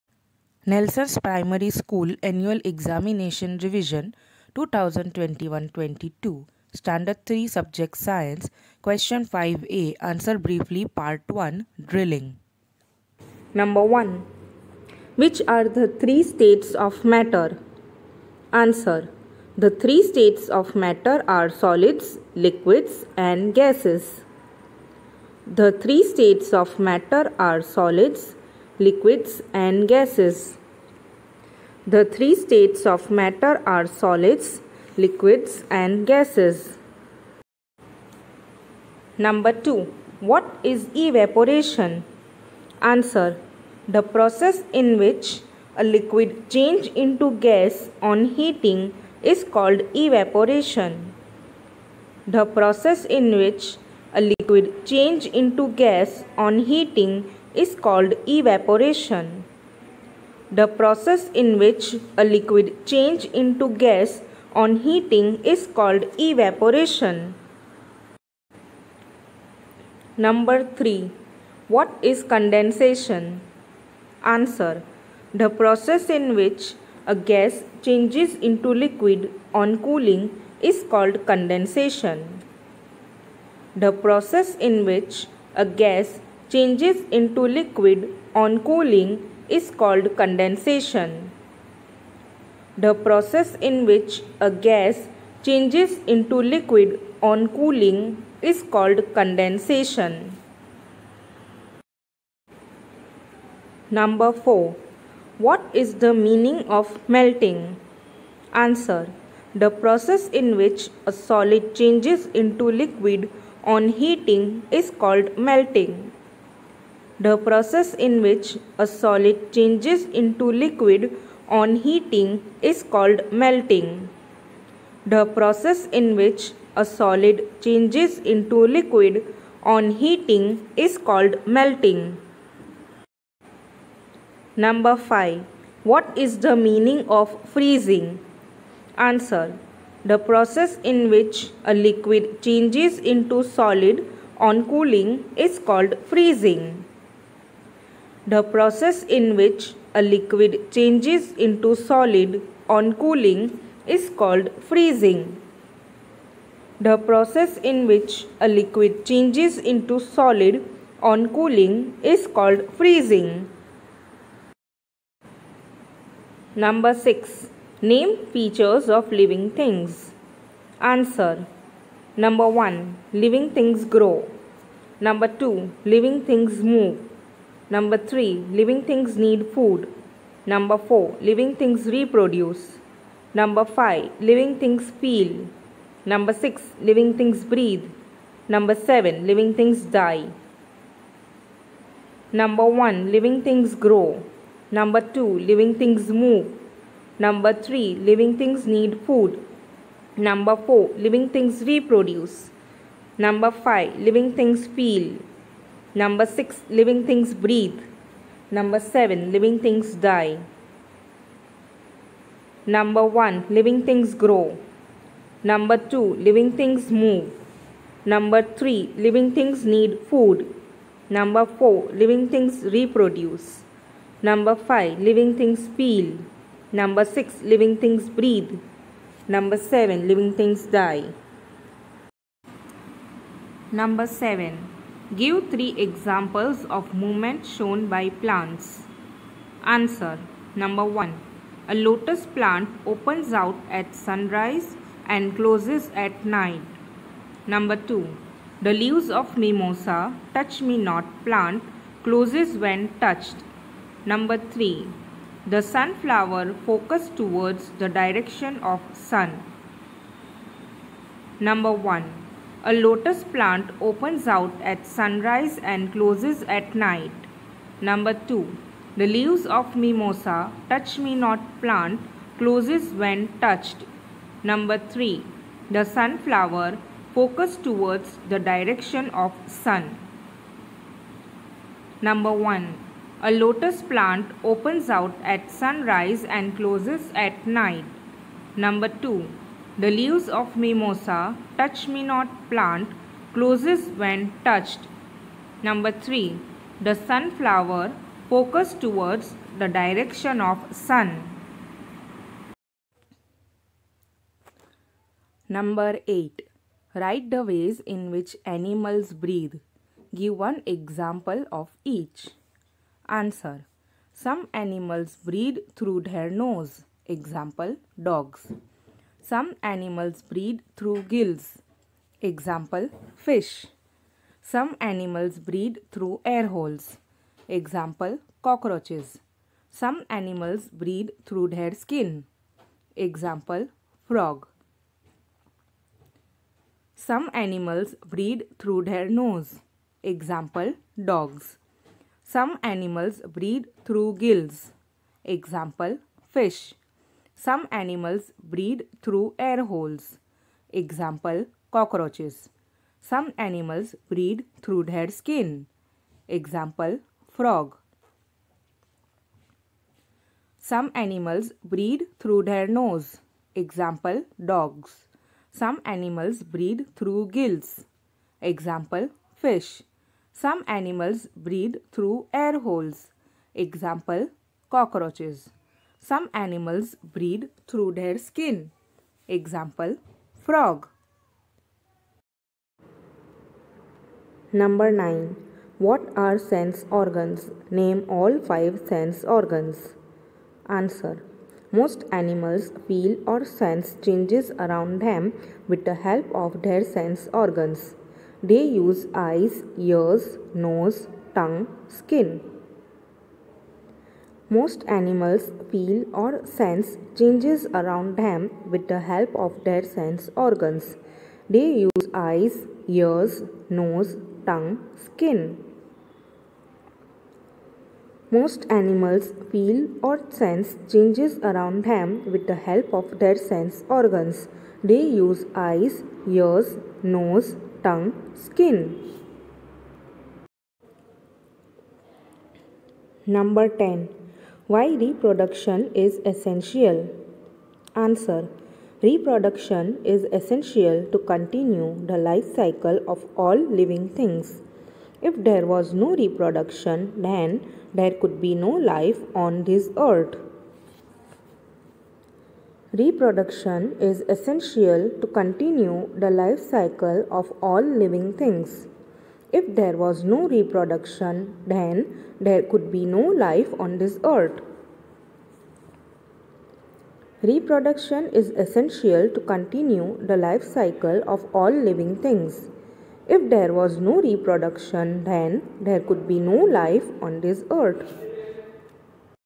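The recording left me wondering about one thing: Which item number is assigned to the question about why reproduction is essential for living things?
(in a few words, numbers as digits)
10.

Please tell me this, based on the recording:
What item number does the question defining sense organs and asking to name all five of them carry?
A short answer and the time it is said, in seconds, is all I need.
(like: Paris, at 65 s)
9, at 384 s.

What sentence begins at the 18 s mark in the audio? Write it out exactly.
Answer The three states of matter are solids, liquids and gases.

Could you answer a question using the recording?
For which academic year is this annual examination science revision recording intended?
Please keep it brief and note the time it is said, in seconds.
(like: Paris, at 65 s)
2021-22, at 4 s.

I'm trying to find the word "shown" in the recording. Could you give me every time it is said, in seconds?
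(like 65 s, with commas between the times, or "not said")
237 s.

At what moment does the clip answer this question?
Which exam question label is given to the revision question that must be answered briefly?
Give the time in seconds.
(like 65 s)
8 s.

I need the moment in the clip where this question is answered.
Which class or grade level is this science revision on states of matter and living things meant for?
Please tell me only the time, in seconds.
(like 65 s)
6 s.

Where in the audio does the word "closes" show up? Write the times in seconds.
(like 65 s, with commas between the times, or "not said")
245 s, 252 s, 265 s, 272 s, 286 s, 293 s.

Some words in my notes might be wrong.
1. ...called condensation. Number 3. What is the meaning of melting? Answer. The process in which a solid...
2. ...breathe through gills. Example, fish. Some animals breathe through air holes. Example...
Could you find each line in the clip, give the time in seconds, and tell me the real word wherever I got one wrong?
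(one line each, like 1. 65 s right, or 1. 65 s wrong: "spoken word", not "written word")
1. 98 s wrong: "4", not "3"
2. 366 s right.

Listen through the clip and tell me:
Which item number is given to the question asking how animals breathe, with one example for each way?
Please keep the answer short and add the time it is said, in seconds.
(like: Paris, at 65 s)
8, at 305 s.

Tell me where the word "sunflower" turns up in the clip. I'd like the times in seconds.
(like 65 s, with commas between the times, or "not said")
255 s, 275 s, 296 s.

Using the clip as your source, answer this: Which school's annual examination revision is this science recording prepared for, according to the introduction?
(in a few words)
Nelson's Primary School.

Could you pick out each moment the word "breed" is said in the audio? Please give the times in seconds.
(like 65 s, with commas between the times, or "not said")
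320 s, 325 s, 330 s, 338 s, 343 s.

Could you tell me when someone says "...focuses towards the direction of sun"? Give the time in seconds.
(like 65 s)
256 s.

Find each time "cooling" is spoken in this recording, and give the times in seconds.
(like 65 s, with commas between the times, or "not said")
79 s, 88 s, 97 s, 144 s, 152 s, 161 s.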